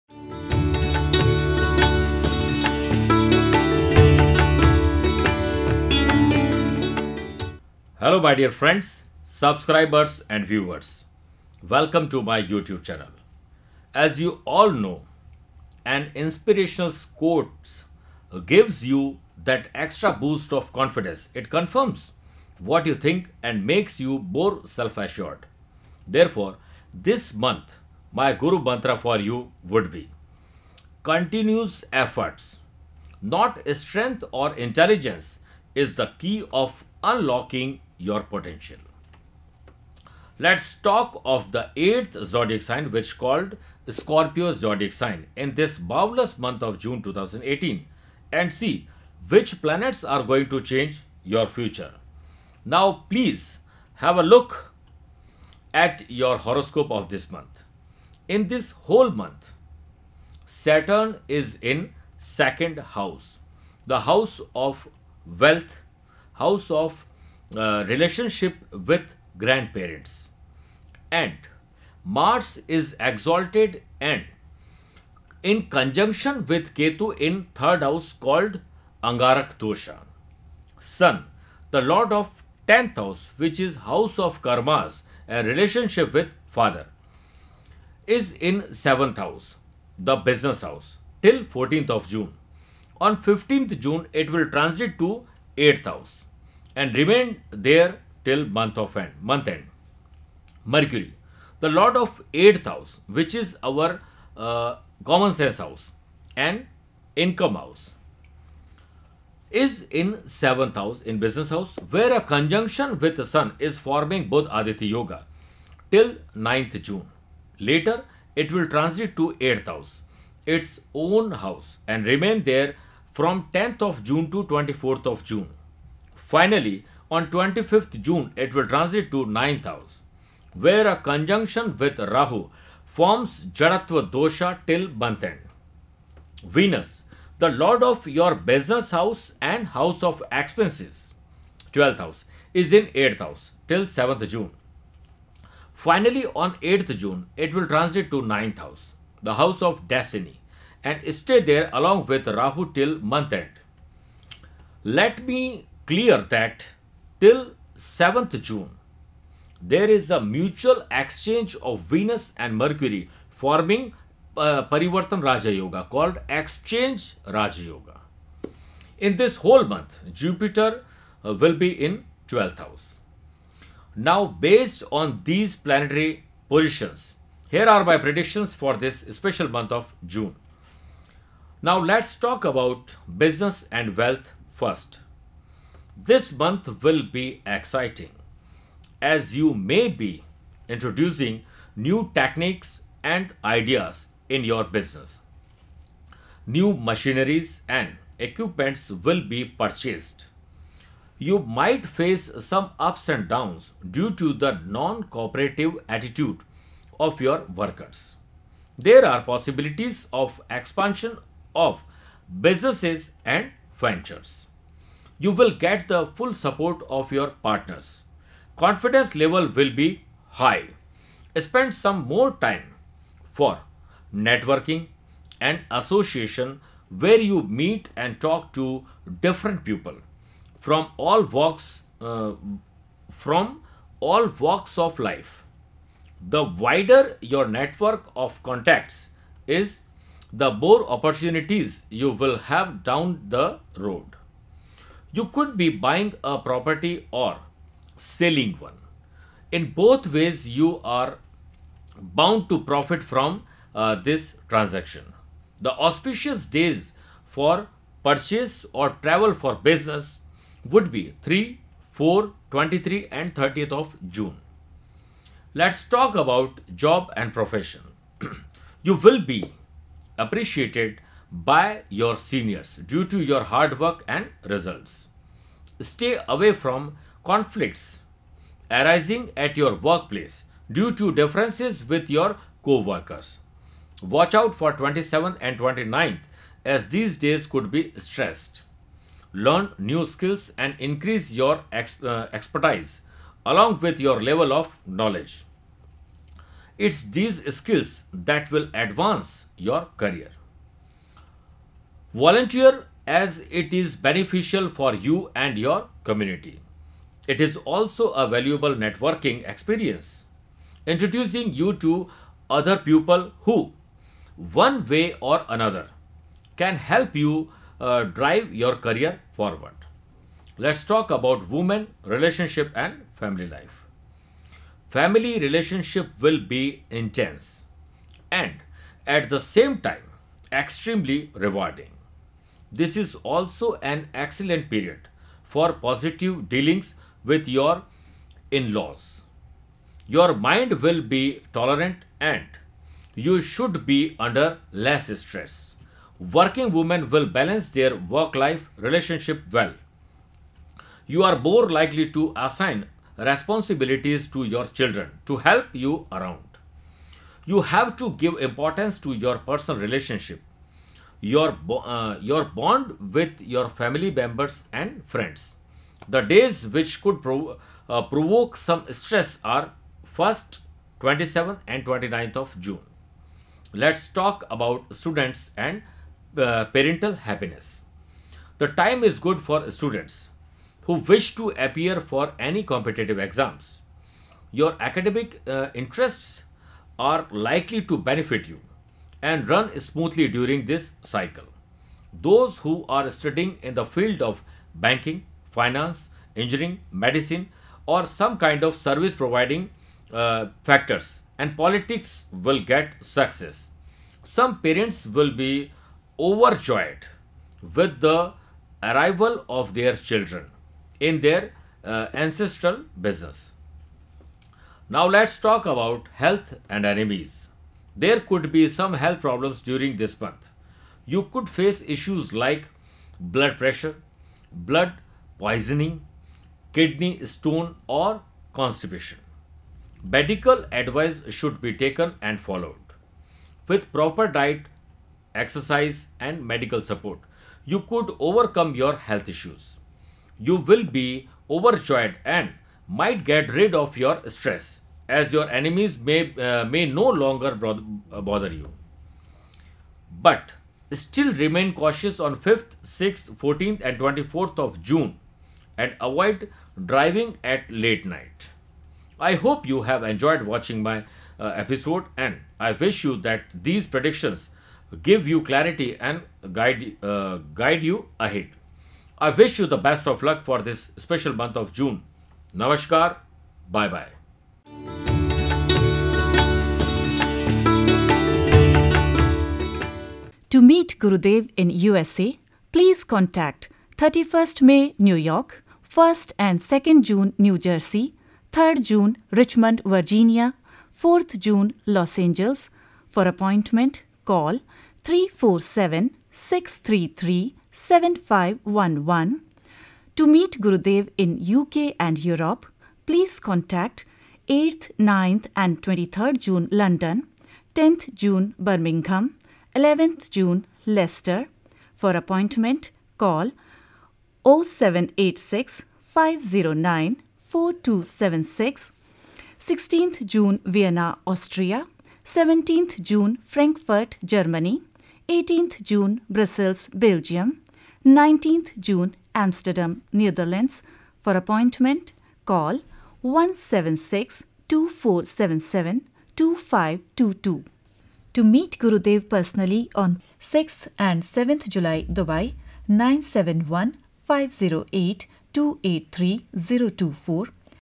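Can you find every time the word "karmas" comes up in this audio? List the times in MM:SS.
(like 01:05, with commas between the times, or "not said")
01:24.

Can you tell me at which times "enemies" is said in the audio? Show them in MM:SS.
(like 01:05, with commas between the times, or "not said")
06:56, 07:25.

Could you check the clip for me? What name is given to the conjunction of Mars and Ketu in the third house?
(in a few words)
Angarak Dosha.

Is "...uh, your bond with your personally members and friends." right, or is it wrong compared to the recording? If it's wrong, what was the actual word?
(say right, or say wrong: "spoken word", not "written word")
wrong: "family", not "personally".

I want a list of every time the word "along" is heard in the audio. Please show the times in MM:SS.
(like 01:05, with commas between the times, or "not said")
02:31, 04:53.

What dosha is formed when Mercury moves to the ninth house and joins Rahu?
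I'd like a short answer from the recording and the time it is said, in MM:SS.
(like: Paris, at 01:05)
Jaratva dosha, at 02:13.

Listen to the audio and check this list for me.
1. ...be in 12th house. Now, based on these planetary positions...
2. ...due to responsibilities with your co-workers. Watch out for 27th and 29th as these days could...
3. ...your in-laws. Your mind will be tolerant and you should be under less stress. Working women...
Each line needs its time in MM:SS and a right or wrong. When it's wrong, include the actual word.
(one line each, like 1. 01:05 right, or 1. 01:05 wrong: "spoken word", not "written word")
1. 02:51 right
2. 04:40 wrong: "differences", not "responsibilities"
3. 05:37 right.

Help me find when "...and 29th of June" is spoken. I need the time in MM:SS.
06:11.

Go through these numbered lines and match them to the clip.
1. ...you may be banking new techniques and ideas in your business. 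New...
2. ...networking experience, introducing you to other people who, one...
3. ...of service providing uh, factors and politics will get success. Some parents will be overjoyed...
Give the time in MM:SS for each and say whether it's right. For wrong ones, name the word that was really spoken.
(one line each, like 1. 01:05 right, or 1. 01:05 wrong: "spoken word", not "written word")
1. 03:09 wrong: "introducing", not "banking"
2. 05:08 right
3. 06:38 right.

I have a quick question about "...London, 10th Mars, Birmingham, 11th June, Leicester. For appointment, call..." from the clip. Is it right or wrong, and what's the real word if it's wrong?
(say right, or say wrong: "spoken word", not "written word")
wrong: "June", not "Mars".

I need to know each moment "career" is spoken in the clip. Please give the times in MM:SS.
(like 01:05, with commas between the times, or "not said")
04:59, 05:18.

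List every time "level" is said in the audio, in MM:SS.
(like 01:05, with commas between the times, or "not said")
03:39, 04:54.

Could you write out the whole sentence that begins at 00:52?
Now, please have a look at your horoscope of this month.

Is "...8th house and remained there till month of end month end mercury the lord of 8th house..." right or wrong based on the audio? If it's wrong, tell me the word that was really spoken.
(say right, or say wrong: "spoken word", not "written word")
right.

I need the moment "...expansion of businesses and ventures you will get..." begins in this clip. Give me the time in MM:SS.
03:30.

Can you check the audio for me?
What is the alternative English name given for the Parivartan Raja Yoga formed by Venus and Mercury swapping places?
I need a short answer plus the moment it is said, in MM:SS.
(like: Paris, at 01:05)
Exchange Raja Yoga, at 02:46.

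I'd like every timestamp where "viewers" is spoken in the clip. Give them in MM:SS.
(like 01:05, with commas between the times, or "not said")
00:10.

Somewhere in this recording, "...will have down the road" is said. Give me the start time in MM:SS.
04:02.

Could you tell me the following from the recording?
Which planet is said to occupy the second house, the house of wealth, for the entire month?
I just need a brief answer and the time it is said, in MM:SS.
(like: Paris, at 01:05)
Saturn, at 01:00.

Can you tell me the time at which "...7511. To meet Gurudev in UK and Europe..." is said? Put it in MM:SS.
08:17.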